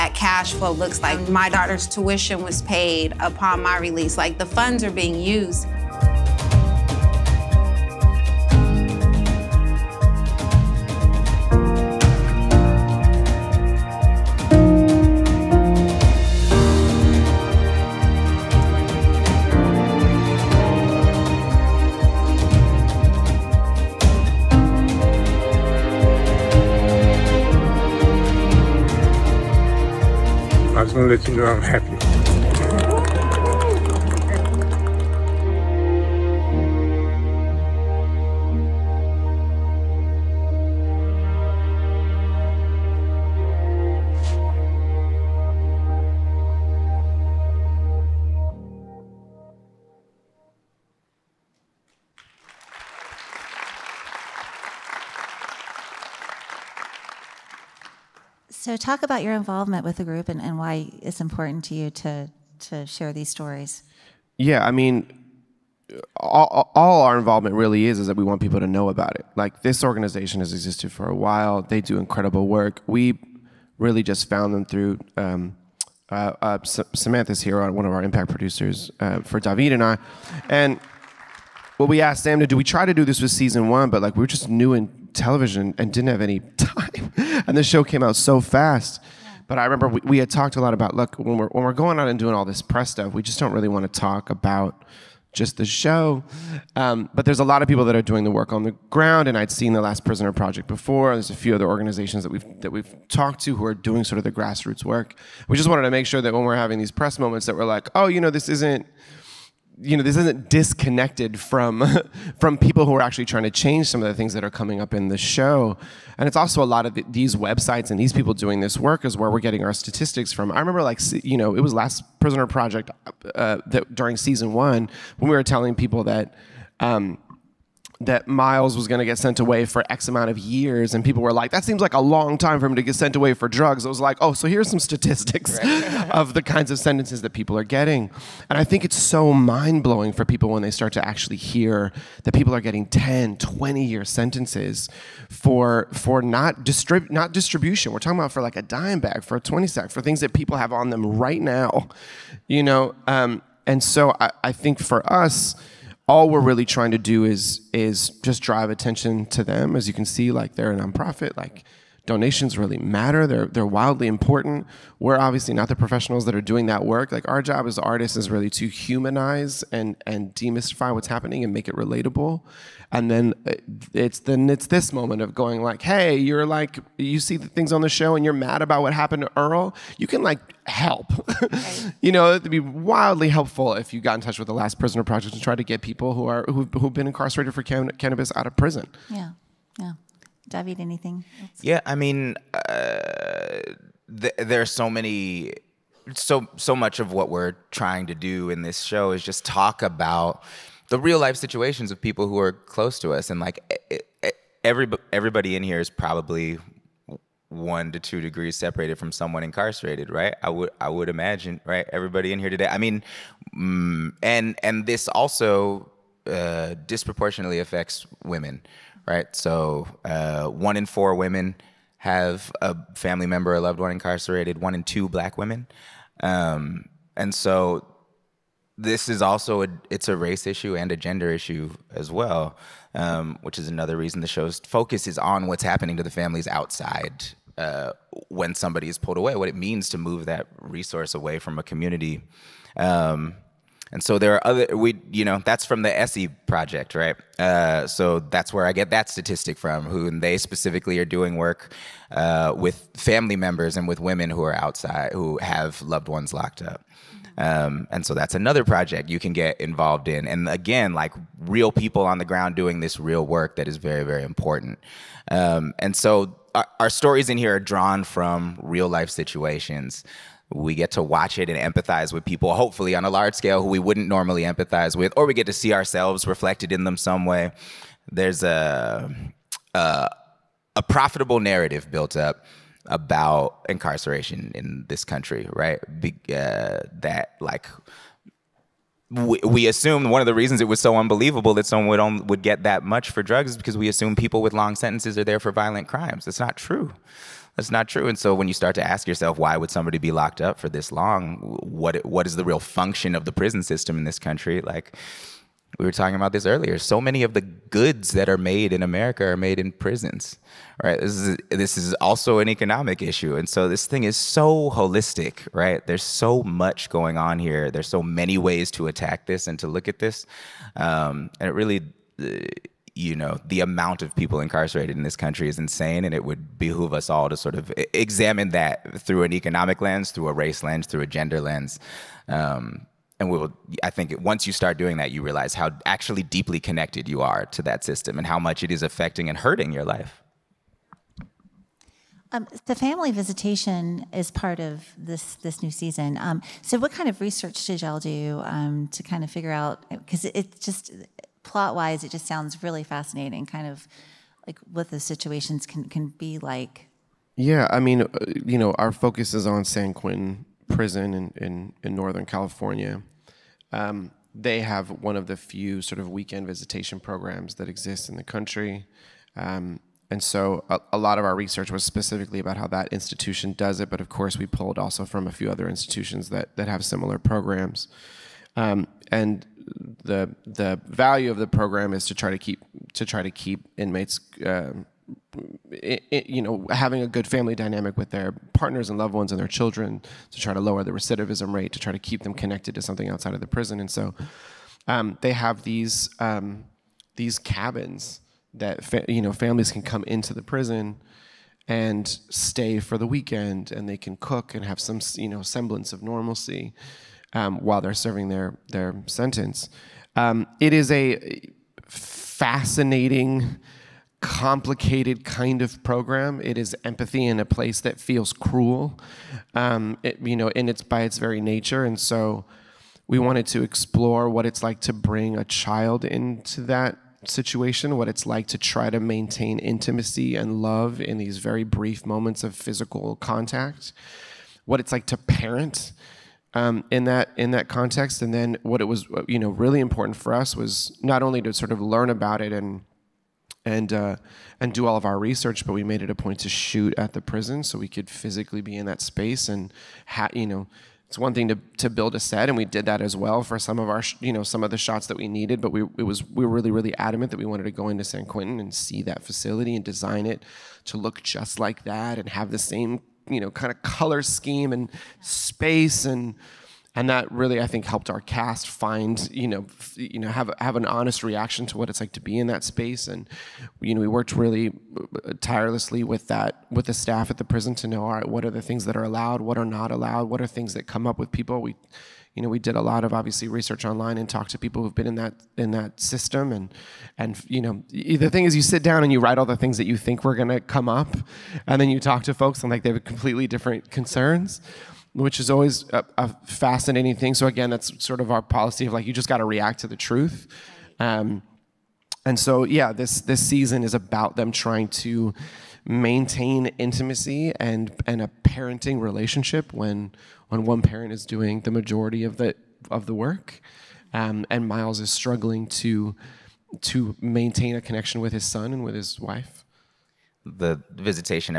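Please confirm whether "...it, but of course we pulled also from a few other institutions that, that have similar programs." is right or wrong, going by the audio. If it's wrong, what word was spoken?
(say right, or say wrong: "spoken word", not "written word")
right.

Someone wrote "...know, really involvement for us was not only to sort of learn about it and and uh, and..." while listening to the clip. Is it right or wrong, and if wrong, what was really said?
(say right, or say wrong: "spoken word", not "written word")
wrong: "important", not "involvement".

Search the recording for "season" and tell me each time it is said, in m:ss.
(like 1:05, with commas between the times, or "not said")
1:23, 2:04, 5:45, 8:23.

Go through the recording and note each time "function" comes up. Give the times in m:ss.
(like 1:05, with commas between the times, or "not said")
5:02.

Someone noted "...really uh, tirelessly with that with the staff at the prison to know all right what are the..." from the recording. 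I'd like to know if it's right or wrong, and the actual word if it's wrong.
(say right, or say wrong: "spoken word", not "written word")
right.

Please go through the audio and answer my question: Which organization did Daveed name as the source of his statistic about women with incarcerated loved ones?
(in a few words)
SE project.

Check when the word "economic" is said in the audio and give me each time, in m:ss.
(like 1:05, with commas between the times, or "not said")
5:12, 5:29.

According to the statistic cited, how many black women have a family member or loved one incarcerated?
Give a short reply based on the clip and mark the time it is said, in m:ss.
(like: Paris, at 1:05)
one in two, at 3:44.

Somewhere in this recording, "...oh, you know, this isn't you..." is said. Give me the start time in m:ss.
1:47.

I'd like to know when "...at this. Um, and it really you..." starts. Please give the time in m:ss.
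5:19.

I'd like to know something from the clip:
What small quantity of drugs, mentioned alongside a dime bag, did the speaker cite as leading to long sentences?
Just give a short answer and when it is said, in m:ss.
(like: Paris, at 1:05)
twenty sack, at 2:29.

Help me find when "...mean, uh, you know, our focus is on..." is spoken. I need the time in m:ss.
5:57.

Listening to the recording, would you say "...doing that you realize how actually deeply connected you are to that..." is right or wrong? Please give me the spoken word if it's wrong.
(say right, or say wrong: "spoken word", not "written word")
right.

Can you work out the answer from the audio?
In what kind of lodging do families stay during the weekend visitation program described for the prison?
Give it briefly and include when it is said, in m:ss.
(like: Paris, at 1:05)
cabins, at 6:37.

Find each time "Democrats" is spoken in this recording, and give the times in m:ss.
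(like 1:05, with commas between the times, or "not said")
not said.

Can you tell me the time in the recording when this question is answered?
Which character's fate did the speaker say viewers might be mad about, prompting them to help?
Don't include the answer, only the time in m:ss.
2:59.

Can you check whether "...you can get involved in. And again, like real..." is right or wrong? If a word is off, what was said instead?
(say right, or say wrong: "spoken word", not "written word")
right.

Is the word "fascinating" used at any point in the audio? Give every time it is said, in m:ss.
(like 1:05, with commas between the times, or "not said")
5:52, 6:51, 8:16.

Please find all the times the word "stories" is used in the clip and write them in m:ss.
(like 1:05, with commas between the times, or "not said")
1:03, 4:26.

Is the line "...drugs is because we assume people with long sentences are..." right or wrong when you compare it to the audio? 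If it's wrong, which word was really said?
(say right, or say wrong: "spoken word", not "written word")
right.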